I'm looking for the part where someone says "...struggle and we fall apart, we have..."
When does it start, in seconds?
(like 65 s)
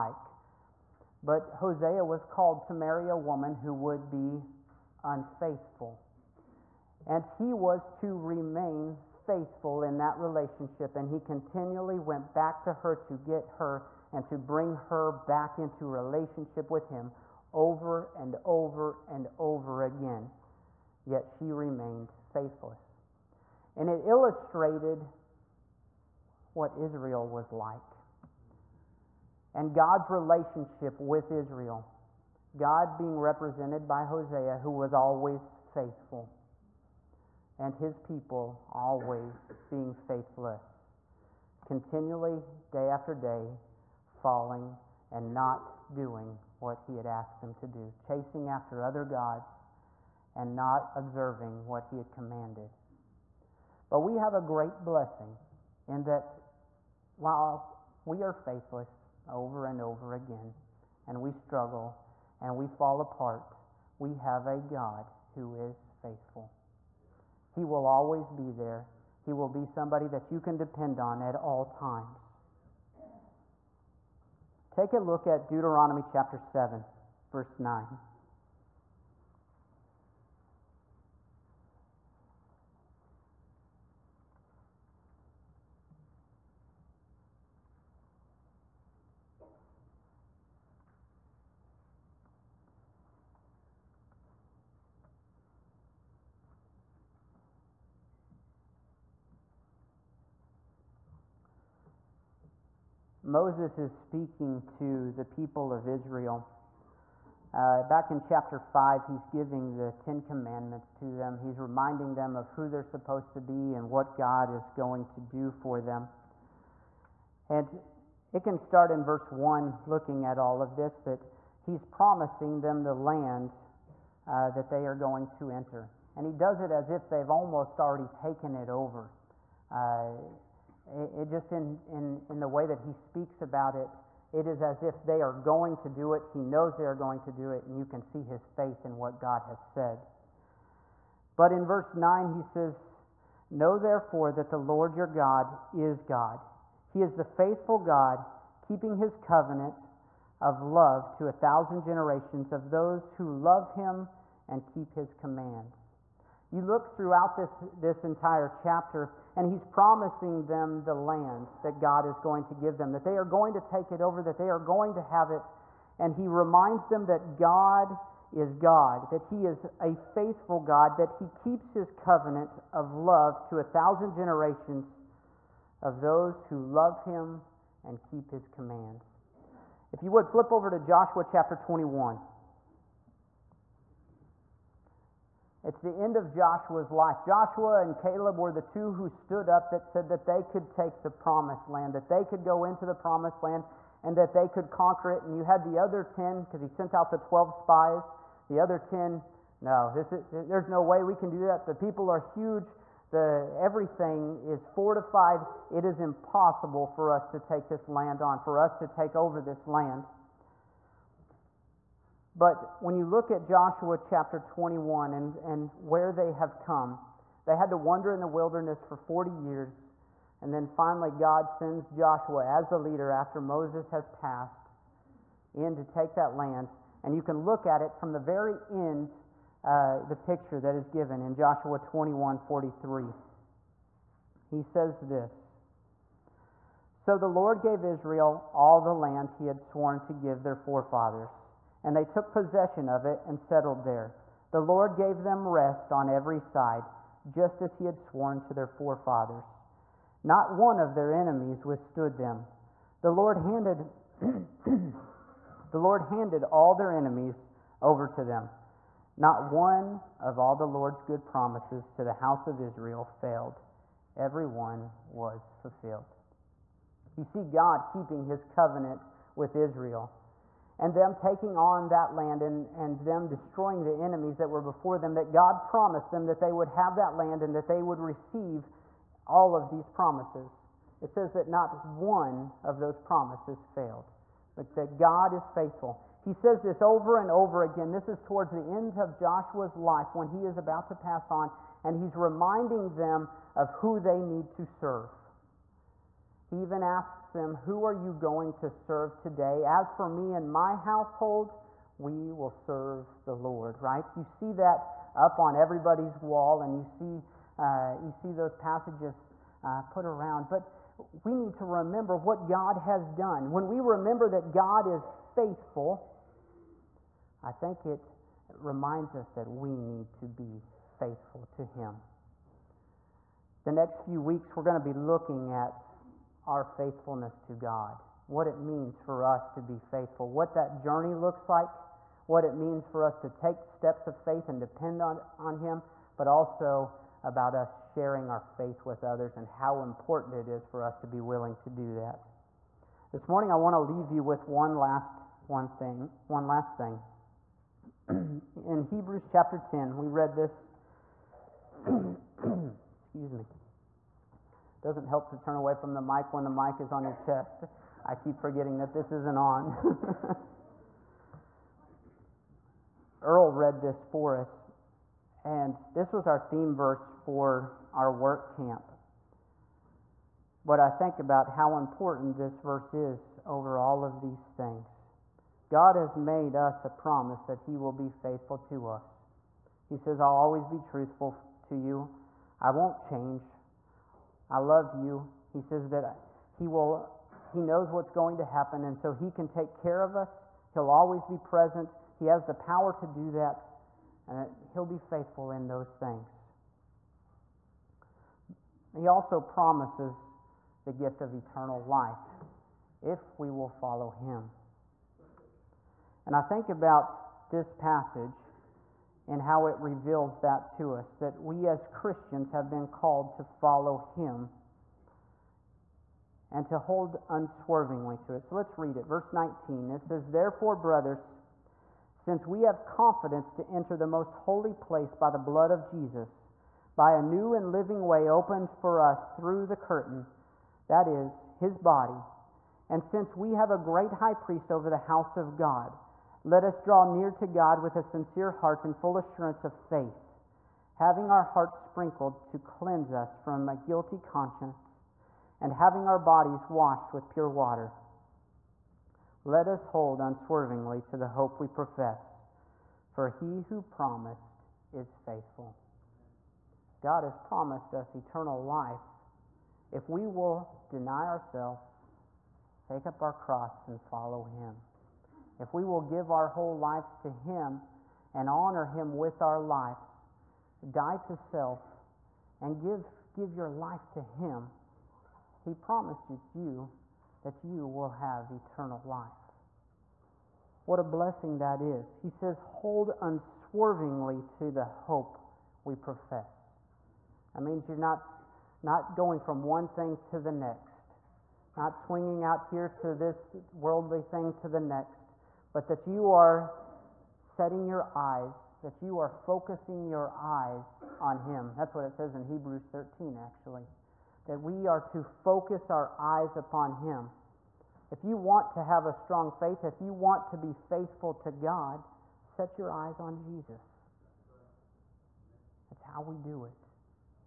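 61 s.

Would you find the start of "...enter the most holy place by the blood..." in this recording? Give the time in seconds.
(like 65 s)
423 s.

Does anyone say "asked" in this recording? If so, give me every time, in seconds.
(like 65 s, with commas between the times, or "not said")
47 s.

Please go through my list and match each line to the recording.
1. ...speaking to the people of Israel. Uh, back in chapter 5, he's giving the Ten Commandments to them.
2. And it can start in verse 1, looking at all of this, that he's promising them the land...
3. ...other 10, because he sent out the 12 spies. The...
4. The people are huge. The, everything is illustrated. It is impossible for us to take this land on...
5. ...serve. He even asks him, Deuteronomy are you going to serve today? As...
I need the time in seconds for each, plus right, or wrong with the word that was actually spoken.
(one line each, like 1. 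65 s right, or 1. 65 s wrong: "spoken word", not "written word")
1. 103 s right
2. 117 s right
3. 195 s right
4. 201 s wrong: "fortified", not "illustrated"
5. 294 s wrong: "Who", not "Deuteronomy".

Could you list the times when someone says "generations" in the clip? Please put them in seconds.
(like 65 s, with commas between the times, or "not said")
151 s, 174 s.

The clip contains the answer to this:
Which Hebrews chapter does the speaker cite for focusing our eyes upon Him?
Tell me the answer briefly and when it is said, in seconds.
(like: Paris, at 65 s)
Hebrews 13, at 502 s.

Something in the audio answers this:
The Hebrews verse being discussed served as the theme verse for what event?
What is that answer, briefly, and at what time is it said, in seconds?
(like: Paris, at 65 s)
work camp, at 368 s.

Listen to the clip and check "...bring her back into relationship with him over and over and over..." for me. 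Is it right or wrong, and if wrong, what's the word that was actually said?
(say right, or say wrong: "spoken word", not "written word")
right.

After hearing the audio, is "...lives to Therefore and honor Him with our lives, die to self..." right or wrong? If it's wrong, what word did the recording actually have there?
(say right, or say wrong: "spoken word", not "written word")
wrong: "Him", not "Therefore".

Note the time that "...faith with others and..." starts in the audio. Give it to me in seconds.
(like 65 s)
338 s.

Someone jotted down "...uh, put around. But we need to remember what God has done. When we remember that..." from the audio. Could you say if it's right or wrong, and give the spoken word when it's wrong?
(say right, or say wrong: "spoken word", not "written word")
right.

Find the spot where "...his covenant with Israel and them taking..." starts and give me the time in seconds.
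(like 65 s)
268 s.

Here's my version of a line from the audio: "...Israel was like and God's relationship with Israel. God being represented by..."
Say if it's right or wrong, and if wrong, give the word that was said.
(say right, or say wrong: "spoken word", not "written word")
right.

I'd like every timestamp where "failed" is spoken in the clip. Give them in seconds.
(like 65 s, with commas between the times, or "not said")
263 s, 283 s.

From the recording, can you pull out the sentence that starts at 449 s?
Let us hold unswervingly to the hope we profess, for he who promised is faithful.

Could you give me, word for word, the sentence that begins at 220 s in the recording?
And then finally, God sends Joshua as the leader after Moses has passed in to take that land.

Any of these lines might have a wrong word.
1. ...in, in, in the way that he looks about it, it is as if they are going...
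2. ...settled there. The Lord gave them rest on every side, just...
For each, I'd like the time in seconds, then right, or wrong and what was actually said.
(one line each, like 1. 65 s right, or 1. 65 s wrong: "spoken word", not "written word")
1. 131 s wrong: "speaks", not "looks"
2. 243 s right.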